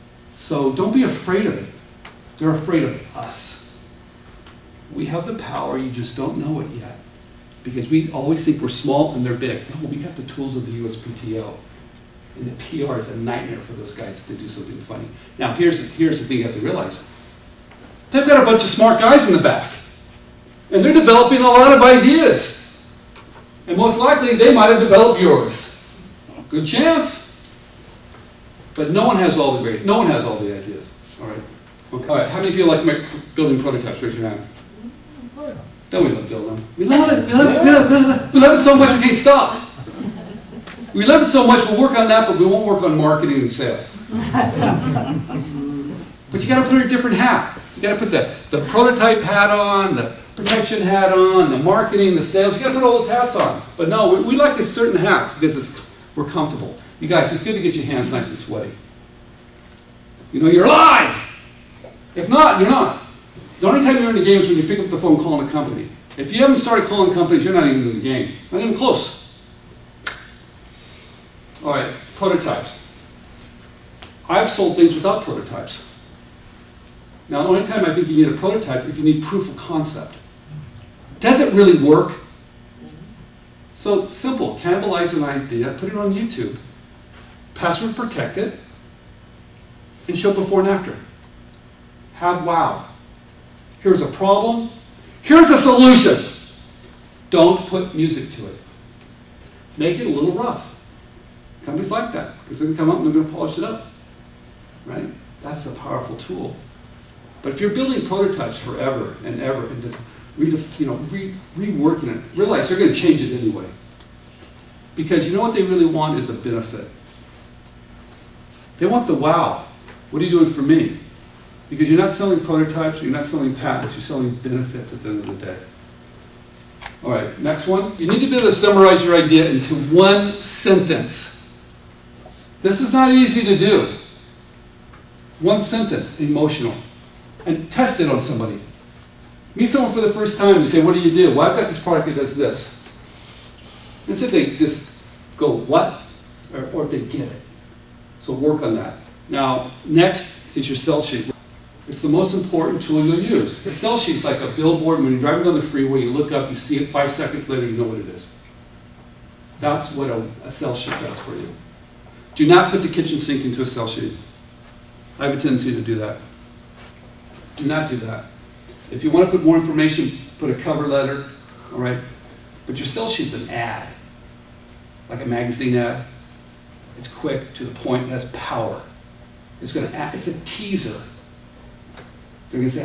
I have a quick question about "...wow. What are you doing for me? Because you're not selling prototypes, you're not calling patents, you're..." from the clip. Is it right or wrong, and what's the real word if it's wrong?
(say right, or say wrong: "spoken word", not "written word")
wrong: "selling", not "calling".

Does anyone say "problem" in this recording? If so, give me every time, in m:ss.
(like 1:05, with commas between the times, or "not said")
1:34.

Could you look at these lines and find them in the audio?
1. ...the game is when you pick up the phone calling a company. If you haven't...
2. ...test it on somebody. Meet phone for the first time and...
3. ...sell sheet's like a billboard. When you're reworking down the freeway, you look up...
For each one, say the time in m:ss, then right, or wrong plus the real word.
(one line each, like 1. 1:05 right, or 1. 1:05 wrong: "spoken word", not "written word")
1. 1:04 right
2. 2:17 wrong: "someone", not "phone"
3. 2:33 wrong: "driving", not "reworking".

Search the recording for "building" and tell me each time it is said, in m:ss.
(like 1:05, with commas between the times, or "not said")
0:33, 1:47.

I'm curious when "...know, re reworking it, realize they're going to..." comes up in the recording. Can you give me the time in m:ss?
1:50.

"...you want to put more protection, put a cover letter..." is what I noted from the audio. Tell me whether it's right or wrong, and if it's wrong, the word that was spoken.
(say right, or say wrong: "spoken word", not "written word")
wrong: "information", not "protection".